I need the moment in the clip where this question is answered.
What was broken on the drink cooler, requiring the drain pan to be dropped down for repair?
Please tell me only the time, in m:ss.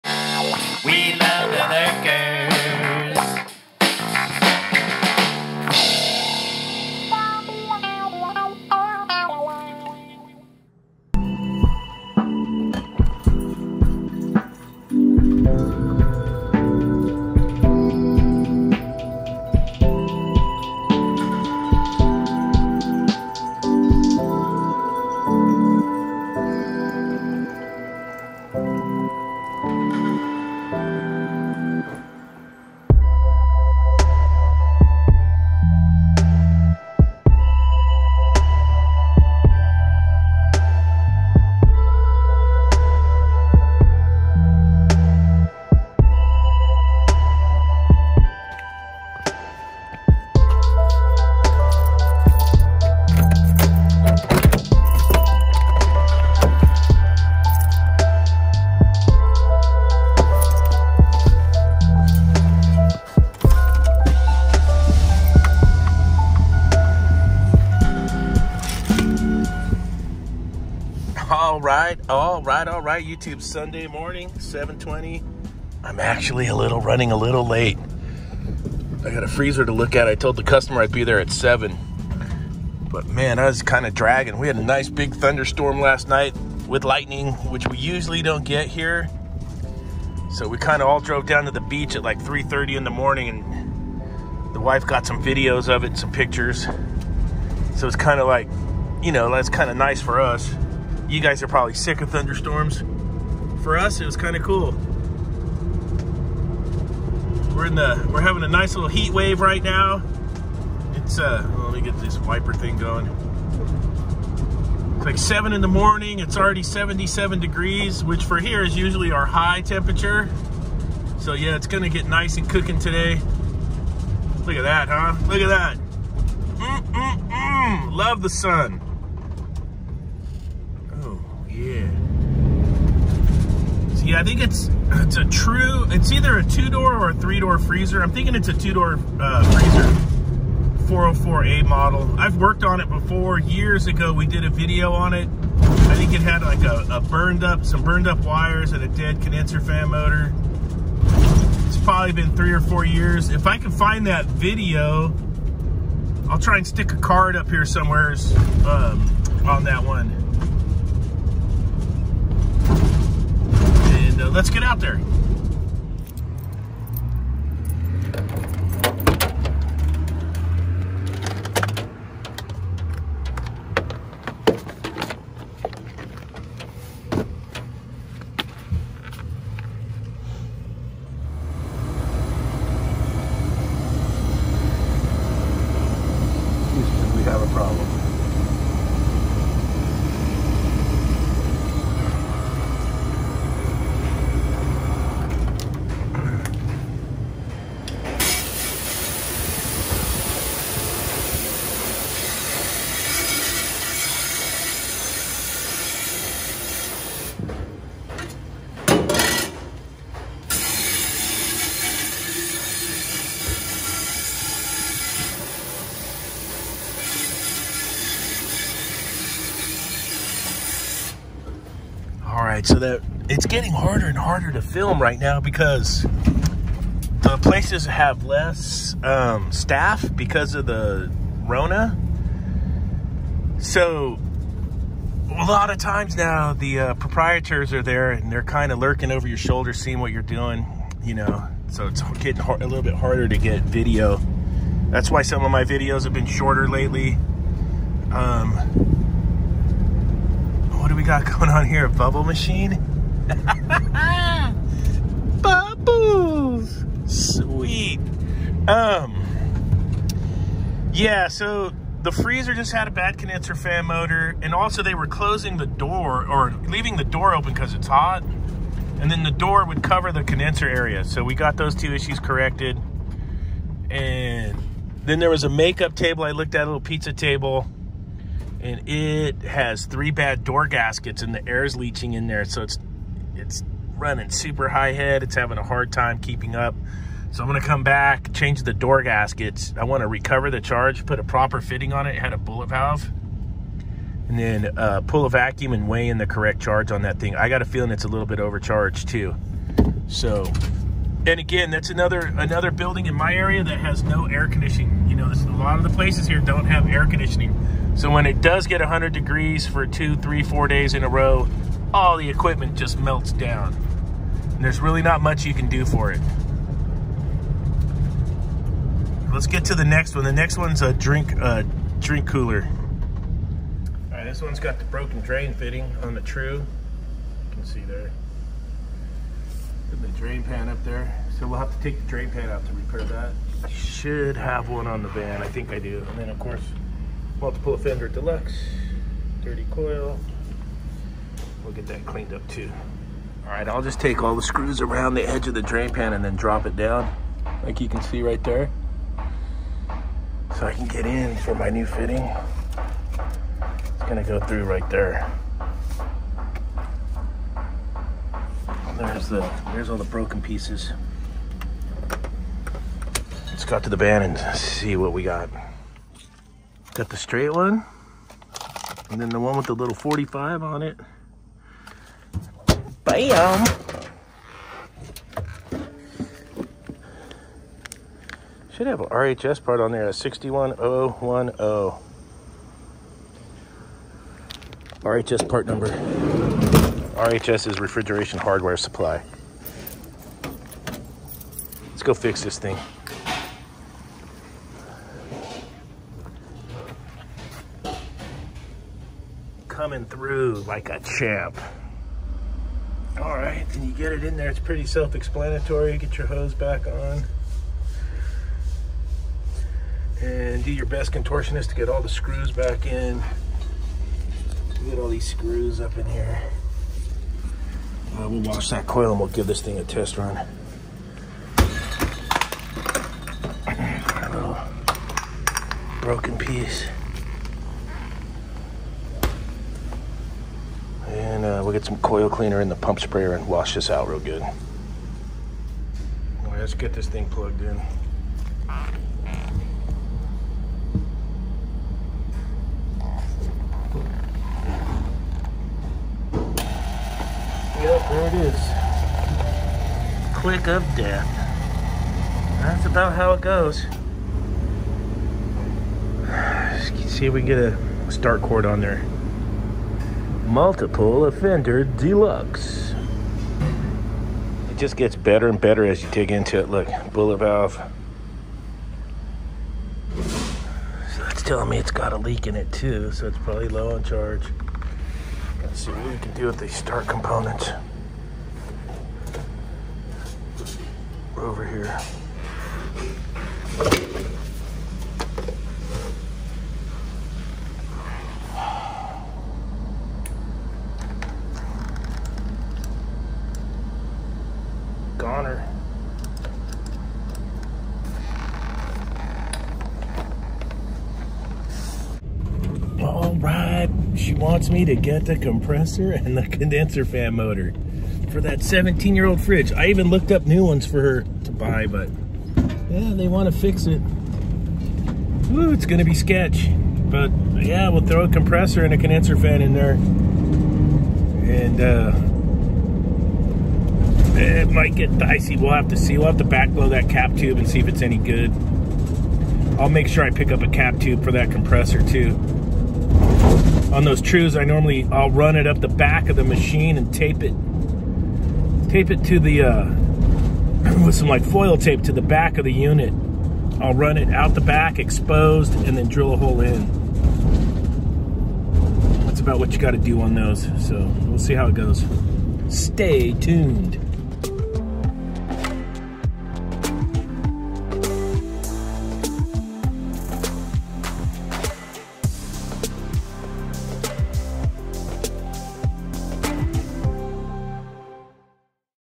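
5:25.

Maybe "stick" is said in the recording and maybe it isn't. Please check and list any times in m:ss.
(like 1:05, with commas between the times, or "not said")
2:36.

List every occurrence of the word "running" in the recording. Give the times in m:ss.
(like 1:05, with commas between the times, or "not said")
1:16, 4:43.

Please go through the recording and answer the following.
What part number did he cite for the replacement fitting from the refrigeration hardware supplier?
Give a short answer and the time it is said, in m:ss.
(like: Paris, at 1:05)
61010, at 6:20.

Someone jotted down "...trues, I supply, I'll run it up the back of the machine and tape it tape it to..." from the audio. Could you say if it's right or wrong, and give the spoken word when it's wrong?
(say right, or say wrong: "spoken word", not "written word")
wrong: "normally", not "supply".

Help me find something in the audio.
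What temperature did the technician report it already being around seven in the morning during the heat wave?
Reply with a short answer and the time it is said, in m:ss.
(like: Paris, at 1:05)
77 degrees, at 1:56.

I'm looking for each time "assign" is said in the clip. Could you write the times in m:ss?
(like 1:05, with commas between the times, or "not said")
not said.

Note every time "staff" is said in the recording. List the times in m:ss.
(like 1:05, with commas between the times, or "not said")
3:49.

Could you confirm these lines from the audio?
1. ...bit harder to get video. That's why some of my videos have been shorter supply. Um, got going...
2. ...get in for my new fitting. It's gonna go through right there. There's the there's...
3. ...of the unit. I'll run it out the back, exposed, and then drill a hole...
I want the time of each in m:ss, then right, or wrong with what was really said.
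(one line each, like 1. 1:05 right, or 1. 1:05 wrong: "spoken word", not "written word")
1. 4:02 wrong: "lately", not "supply"
2. 5:50 right
3. 9:02 right.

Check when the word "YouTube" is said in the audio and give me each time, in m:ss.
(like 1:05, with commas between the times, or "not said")
1:13.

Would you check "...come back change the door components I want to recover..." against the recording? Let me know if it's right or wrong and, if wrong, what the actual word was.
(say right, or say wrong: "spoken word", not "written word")
wrong: "gaskets", not "components".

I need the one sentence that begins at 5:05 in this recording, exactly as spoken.
You know, this, a lot of the places here don't have air conditioning.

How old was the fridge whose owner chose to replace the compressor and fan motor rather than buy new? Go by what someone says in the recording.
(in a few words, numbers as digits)
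17 years.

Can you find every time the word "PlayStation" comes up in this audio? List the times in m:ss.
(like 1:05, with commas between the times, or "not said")
not said.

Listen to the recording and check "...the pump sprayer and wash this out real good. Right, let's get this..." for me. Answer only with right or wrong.
right.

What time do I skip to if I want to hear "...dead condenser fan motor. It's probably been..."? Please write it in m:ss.
2:28.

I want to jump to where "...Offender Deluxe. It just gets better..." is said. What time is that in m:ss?
7:41.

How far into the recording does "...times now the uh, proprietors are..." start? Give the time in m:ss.
3:55.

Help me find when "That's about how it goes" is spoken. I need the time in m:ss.
7:32.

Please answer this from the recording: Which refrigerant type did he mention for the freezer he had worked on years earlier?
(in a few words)
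404A.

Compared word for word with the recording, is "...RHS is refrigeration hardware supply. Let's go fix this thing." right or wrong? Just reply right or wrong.
right.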